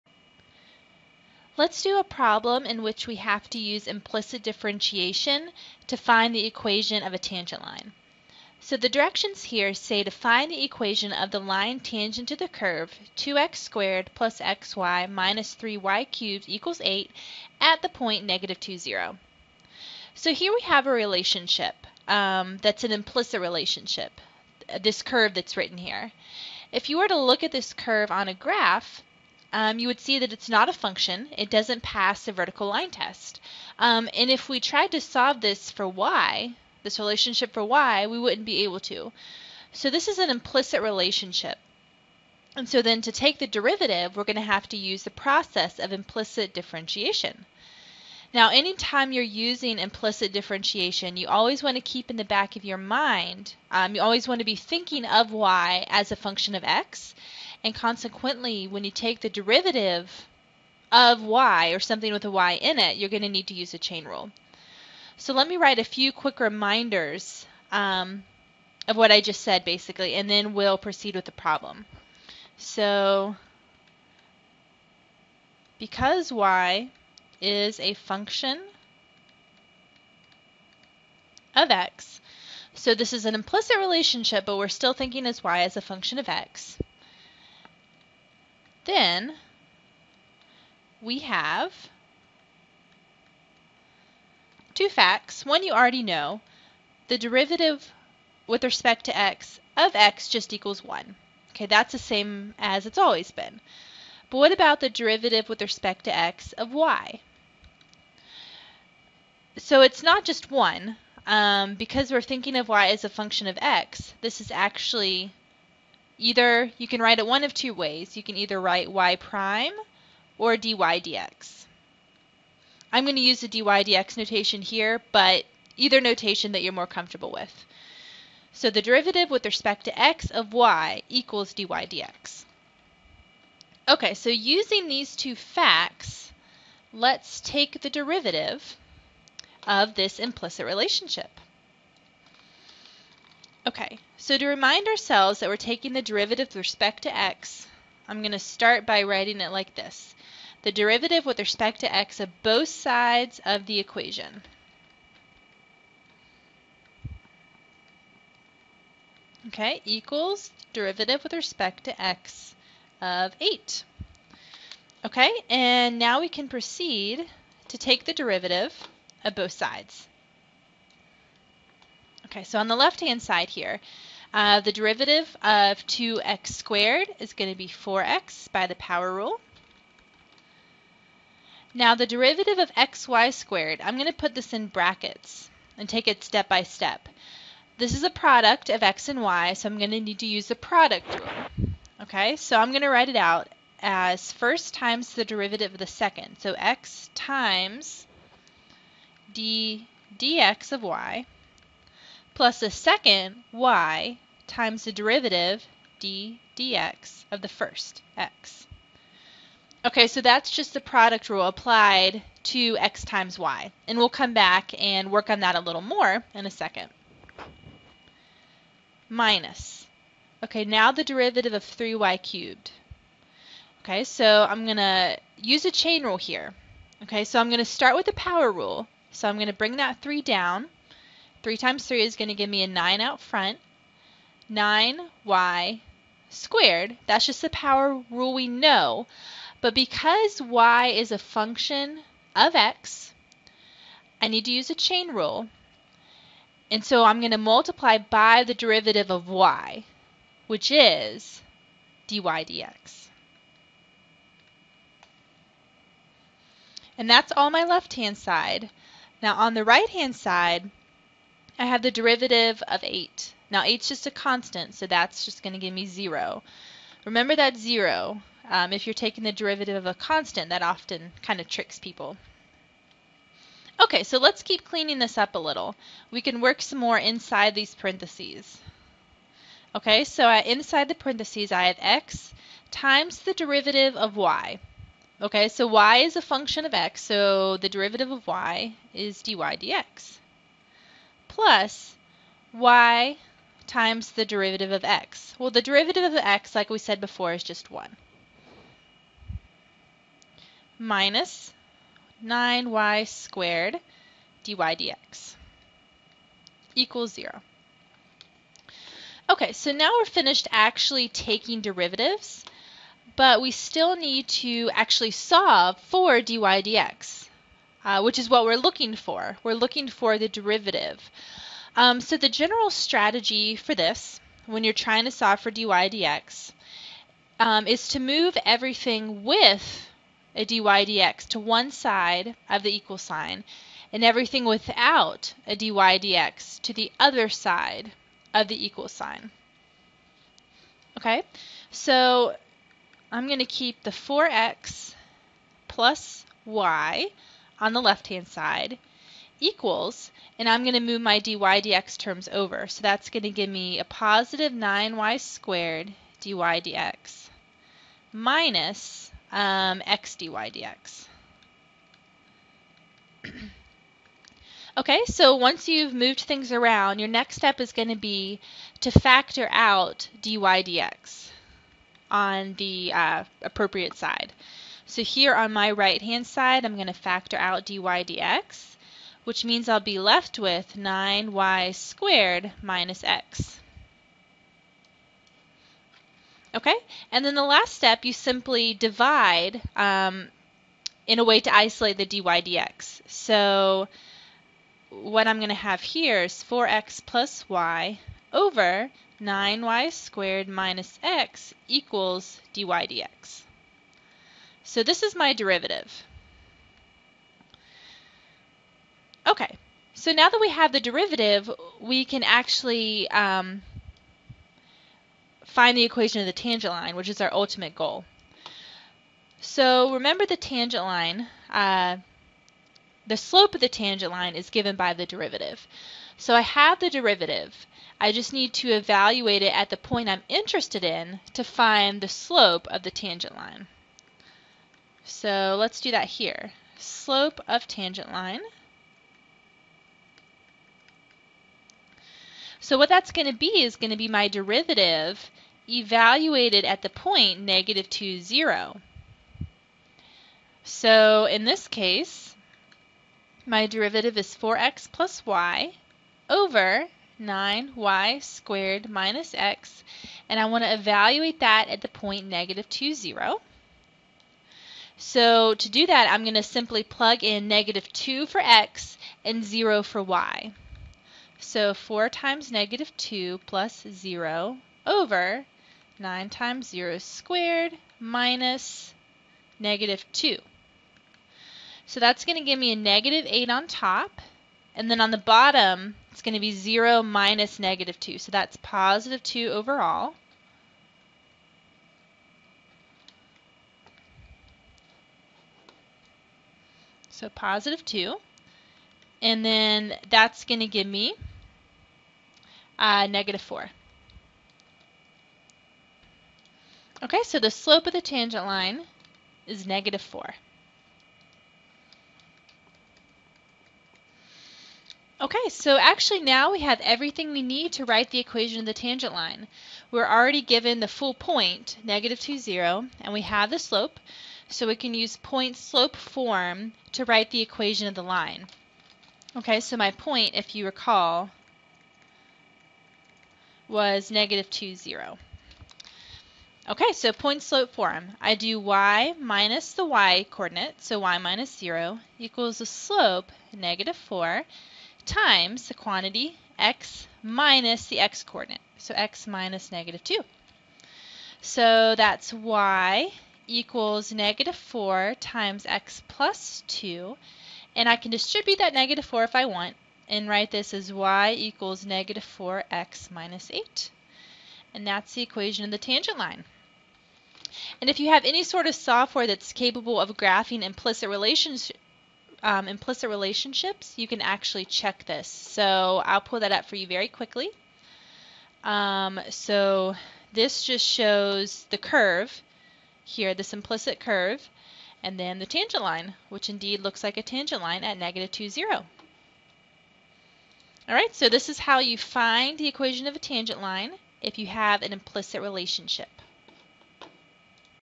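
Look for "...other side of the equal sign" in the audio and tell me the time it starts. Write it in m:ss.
5:36.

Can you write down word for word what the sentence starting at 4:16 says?
And that's all my left-hand side.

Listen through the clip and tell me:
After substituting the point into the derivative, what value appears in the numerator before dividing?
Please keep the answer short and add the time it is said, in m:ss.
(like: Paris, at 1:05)
-8, at 8:02.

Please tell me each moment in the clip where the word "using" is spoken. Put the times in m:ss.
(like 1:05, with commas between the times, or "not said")
0:49, 2:14.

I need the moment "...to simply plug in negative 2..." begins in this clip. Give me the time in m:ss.
7:46.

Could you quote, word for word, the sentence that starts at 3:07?
This is a product of x and y, so I'm going to need to use the product rule.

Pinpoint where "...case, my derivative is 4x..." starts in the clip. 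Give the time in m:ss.
7:31.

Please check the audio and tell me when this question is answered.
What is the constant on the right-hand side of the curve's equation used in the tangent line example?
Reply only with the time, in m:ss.
0:16.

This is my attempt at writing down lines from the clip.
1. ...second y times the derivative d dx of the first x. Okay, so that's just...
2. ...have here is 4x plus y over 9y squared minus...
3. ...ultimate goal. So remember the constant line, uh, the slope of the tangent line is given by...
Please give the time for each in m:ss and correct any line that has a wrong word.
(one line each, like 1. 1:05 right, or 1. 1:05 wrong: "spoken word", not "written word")
1. 3:22 right
2. 6:35 right
3. 6:57 wrong: "tangent", not "constant".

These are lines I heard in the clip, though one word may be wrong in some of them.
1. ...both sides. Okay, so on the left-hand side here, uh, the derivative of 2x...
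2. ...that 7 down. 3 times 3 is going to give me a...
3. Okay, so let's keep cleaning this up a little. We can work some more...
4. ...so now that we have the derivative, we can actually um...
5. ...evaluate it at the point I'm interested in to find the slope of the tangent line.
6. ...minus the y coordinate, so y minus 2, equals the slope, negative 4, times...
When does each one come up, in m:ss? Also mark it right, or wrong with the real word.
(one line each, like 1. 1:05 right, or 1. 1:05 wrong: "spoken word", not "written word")
1. 2:49 right
2. 3:49 wrong: "3", not "7"
3. 4:33 right
4. 6:49 right
5. 7:08 right
6. 8:59 wrong: "0", not "2".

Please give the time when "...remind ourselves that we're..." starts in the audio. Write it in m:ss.
2:24.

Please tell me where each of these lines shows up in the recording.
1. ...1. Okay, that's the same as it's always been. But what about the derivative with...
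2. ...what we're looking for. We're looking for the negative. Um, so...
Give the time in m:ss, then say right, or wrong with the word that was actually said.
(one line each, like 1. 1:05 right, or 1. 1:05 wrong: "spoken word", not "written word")
1. 1:40 right
2. 5:18 wrong: "derivative", not "negative".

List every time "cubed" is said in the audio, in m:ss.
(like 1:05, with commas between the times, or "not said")
0:16, 3:42.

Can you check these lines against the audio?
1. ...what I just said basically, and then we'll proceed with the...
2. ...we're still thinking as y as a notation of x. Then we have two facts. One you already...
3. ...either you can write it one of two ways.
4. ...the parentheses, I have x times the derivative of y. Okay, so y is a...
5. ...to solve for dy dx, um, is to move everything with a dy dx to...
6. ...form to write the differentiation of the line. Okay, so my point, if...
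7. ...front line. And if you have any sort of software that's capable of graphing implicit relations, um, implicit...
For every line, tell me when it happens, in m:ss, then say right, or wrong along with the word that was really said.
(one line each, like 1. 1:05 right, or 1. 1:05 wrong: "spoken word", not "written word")
1. 1:08 right
2. 1:24 wrong: "function", not "notation"
3. 1:56 right
4. 4:40 right
5. 5:25 right
6. 8:45 wrong: "equation", not "differentiation"
7. 9:25 wrong: "tangent", not "front".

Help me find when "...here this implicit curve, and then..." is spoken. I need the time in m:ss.
9:43.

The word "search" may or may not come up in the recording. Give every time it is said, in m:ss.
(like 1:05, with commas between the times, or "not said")
not said.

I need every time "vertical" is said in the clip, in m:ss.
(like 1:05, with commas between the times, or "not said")
0:32.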